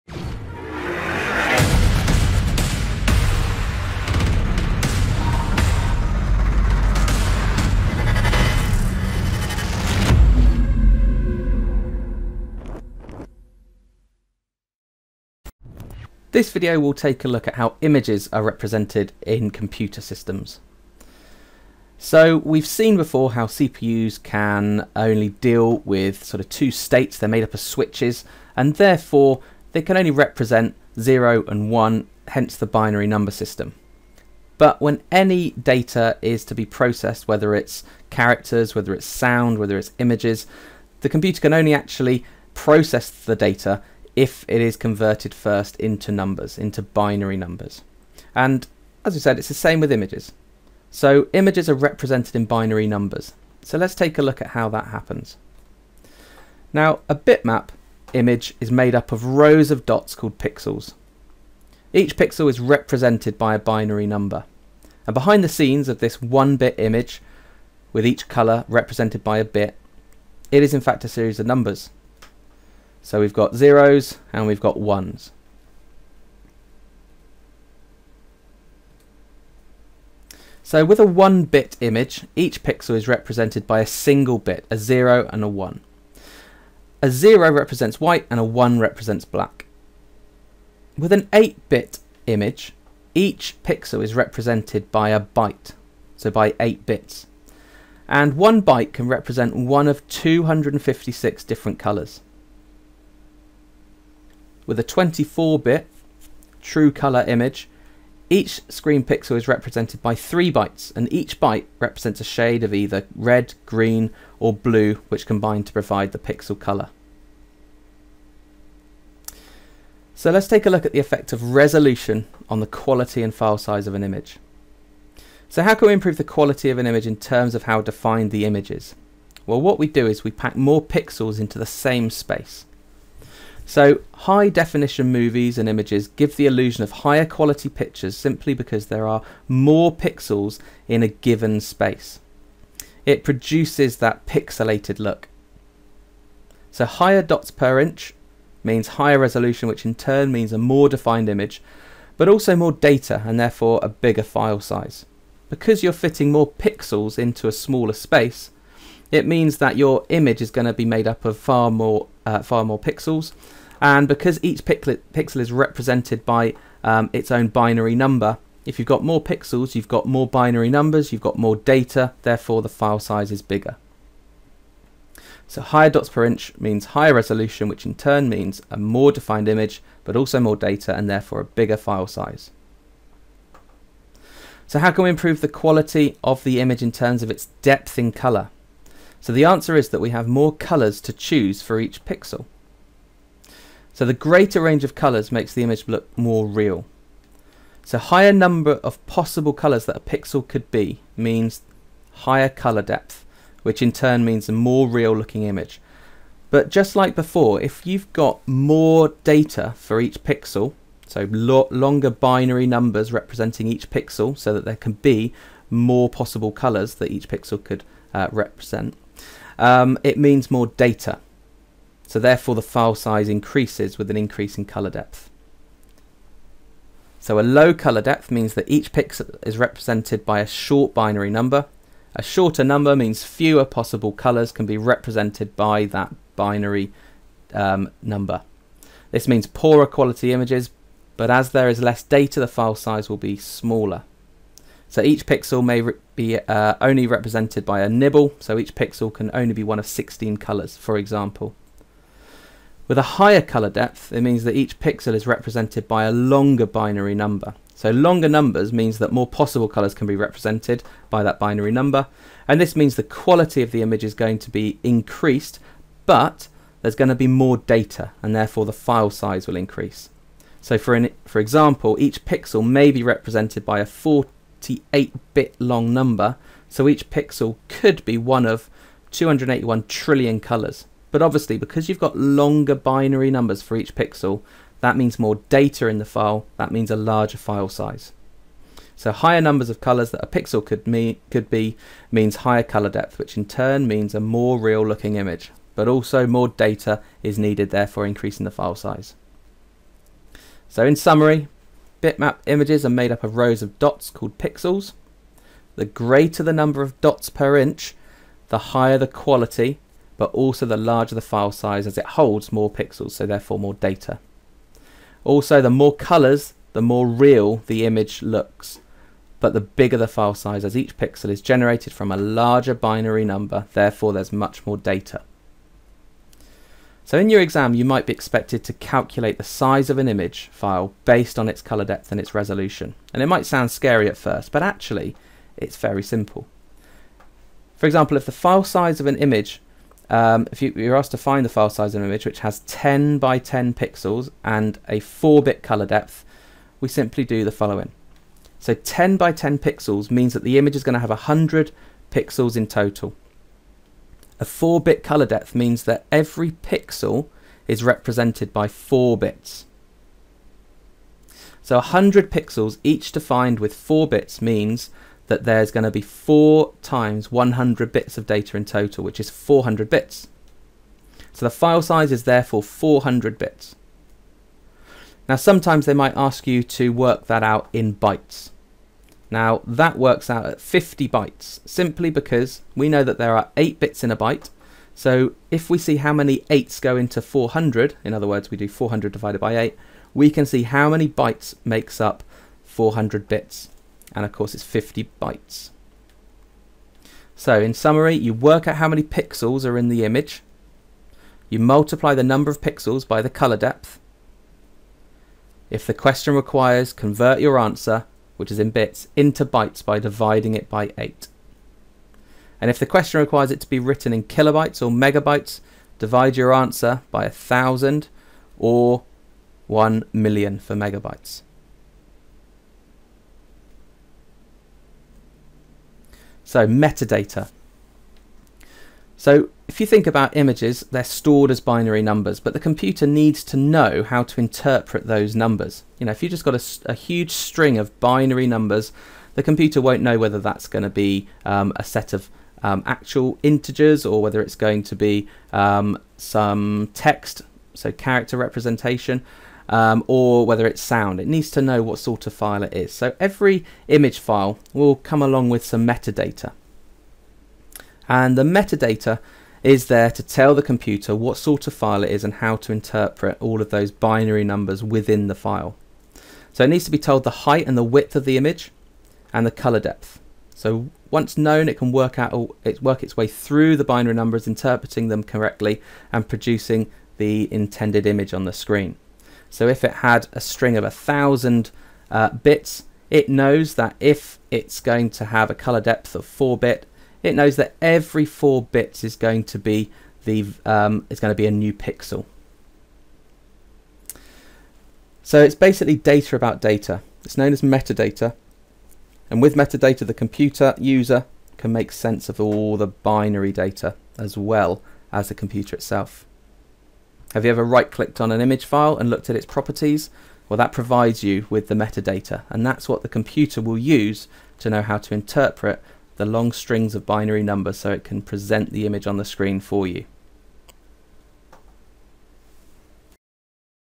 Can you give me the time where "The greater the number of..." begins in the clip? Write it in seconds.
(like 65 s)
305 s.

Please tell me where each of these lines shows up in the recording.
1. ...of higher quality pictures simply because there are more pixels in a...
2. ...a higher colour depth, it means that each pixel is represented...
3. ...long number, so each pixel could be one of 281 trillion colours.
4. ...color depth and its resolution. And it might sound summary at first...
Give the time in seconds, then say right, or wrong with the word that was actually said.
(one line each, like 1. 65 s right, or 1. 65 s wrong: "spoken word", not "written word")
1. 136 s right
2. 252 s right
3. 275 s right
4. 331 s wrong: "scary", not "summary".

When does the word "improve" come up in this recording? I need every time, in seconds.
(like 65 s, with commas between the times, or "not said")
125 s, 185 s.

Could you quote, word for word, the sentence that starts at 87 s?
A zero represents white and a one represents black.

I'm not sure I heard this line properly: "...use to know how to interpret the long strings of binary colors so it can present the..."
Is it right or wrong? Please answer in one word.
wrong.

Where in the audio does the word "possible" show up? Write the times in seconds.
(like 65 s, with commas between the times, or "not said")
199 s, 216 s, 233 s, 259 s.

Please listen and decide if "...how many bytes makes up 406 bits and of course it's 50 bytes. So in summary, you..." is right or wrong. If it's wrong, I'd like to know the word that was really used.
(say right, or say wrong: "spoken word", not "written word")
wrong: "400", not "406".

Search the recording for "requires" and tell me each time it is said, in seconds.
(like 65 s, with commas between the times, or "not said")
406 s, 413 s.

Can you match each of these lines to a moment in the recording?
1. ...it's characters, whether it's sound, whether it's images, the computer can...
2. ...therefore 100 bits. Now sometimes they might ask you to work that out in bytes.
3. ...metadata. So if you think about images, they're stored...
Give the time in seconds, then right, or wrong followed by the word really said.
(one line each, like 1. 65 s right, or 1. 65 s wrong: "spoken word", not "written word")
1. 37 s right
2. 372 s wrong: "400", not "100"
3. 426 s right.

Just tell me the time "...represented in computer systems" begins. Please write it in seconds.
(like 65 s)
18 s.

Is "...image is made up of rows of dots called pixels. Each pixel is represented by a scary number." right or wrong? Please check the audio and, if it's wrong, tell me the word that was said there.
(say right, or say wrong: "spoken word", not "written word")
wrong: "binary", not "scary".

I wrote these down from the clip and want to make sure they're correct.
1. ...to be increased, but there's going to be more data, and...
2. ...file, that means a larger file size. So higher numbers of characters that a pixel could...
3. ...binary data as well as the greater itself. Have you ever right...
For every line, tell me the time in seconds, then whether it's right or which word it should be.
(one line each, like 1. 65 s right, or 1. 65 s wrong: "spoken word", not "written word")
1. 264 s right
2. 286 s wrong: "colors", not "characters"
3. 502 s wrong: "computer", not "greater".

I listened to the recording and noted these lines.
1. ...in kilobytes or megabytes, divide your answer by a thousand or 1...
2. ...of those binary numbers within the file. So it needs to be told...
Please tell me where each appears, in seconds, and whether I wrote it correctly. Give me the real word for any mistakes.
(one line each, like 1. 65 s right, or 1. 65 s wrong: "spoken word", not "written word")
1. 414 s right
2. 463 s right.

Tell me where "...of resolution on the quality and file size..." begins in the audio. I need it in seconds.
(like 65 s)
121 s.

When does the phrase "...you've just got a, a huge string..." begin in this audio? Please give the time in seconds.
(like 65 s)
436 s.